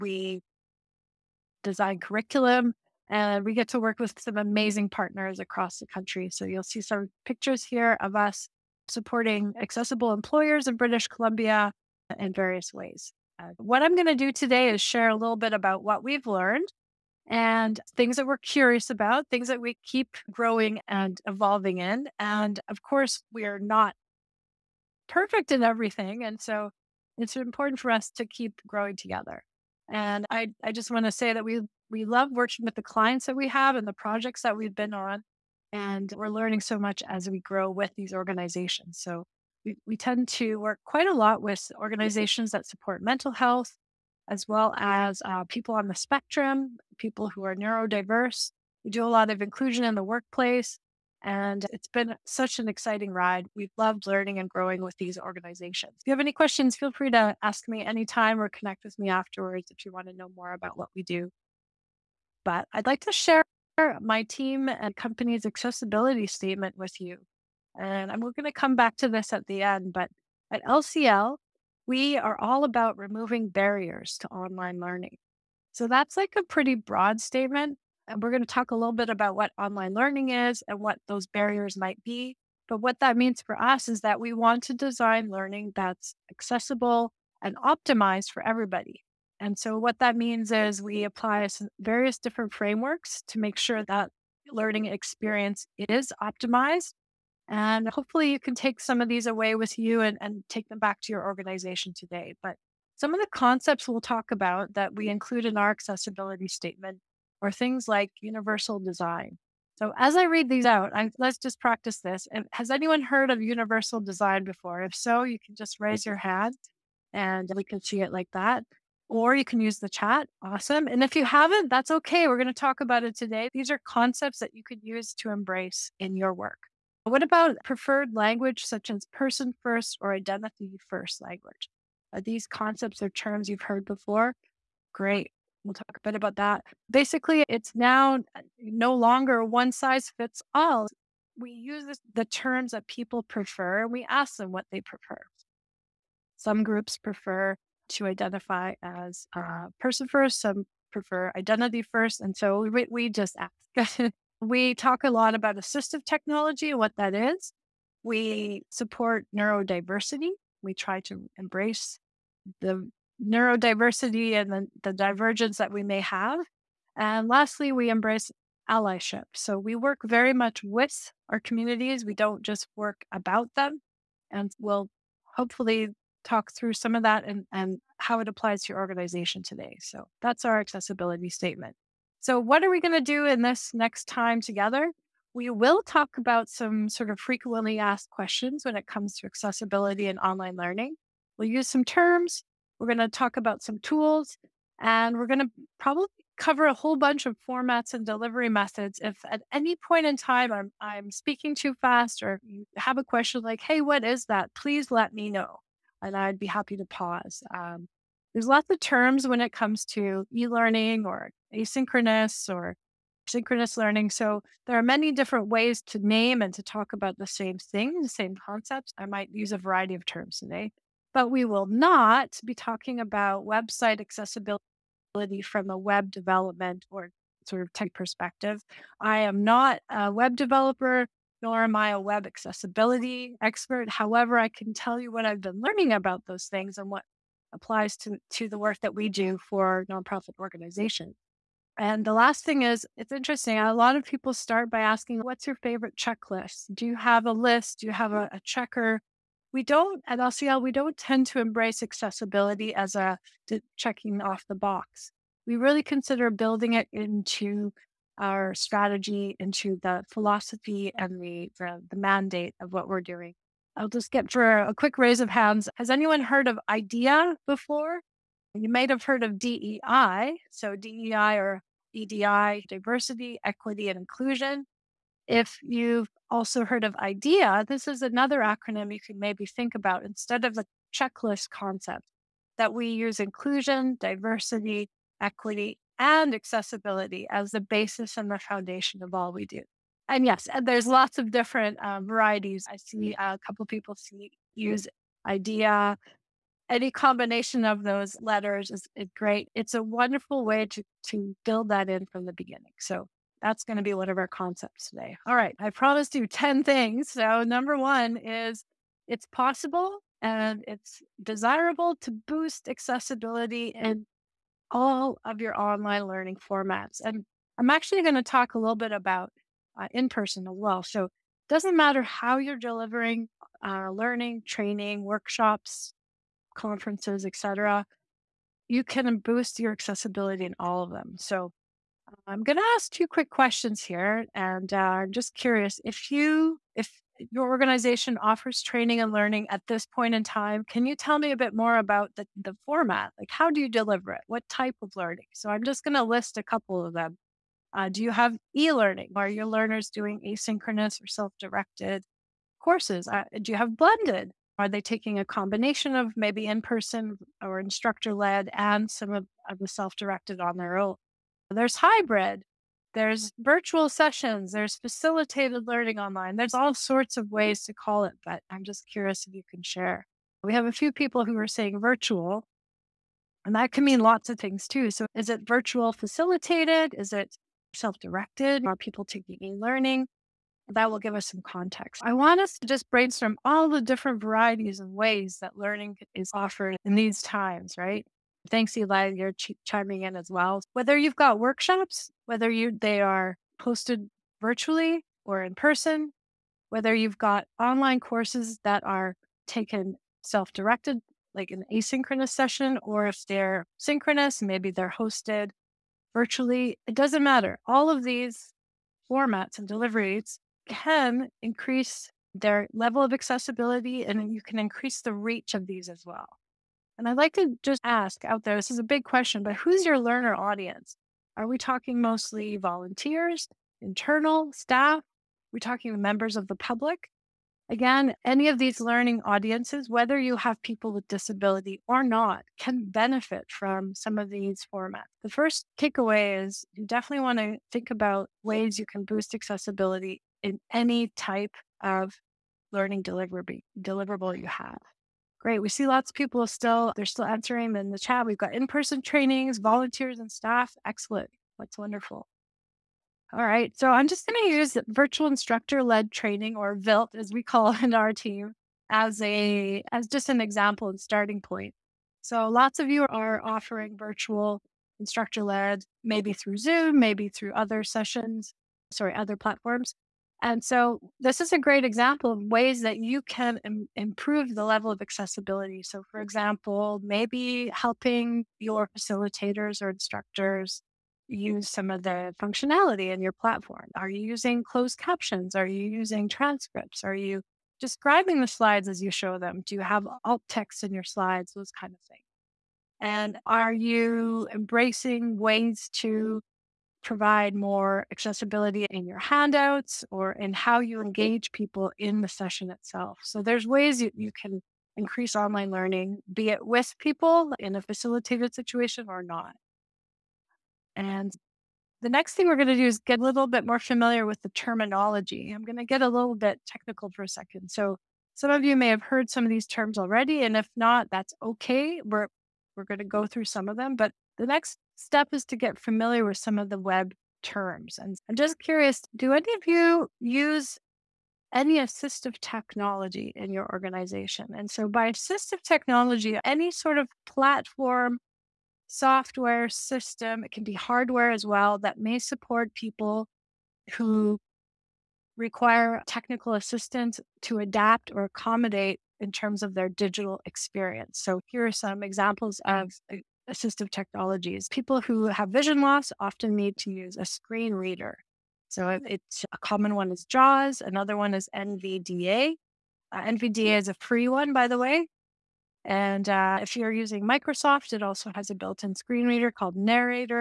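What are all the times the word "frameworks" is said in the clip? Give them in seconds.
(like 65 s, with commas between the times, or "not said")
92 s.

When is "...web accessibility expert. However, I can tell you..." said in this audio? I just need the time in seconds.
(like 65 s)
232 s.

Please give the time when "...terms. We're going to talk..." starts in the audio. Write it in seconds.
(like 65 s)
191 s.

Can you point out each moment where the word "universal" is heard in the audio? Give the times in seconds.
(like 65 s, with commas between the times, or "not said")
108 s, 113 s.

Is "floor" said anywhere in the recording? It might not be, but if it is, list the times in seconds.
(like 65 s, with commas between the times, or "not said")
not said.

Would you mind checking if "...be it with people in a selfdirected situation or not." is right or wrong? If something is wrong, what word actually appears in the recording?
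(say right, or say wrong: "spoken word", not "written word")
wrong: "facilitated", not "selfdirected".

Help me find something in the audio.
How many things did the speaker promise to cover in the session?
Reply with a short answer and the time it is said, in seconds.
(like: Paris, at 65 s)
10, at 306 s.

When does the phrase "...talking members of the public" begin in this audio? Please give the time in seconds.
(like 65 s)
425 s.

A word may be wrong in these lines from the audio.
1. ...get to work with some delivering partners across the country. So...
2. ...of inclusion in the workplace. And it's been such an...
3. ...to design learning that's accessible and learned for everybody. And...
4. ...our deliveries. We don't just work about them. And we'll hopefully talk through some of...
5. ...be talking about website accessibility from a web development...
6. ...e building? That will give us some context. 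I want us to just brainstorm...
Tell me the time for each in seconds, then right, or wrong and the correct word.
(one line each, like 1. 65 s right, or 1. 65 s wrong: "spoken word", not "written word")
1. 3 s wrong: "amazing", not "delivering"
2. 49 s right
3. 84 s wrong: "optimized", not "learned"
4. 171 s wrong: "communities", not "deliveries"
5. 222 s right
6. 379 s wrong: "learning", not "building".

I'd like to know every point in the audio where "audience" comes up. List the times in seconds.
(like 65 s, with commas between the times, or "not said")
420 s, 429 s.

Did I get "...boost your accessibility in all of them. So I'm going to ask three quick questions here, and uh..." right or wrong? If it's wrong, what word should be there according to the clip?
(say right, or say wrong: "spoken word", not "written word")
wrong: "two", not "three".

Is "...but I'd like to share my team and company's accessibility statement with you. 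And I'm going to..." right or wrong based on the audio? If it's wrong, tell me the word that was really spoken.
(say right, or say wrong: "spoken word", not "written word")
right.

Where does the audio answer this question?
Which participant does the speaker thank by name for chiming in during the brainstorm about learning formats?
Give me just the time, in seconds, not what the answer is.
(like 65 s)
388 s.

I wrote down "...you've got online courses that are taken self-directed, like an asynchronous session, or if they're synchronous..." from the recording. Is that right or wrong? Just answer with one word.
right.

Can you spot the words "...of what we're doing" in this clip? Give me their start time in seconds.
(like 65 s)
262 s.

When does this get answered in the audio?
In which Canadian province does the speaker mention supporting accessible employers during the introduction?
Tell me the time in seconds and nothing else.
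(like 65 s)
10 s.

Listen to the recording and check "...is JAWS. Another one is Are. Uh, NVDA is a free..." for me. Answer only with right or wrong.
wrong.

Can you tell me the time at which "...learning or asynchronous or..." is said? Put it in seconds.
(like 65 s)
210 s.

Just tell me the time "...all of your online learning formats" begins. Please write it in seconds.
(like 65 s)
314 s.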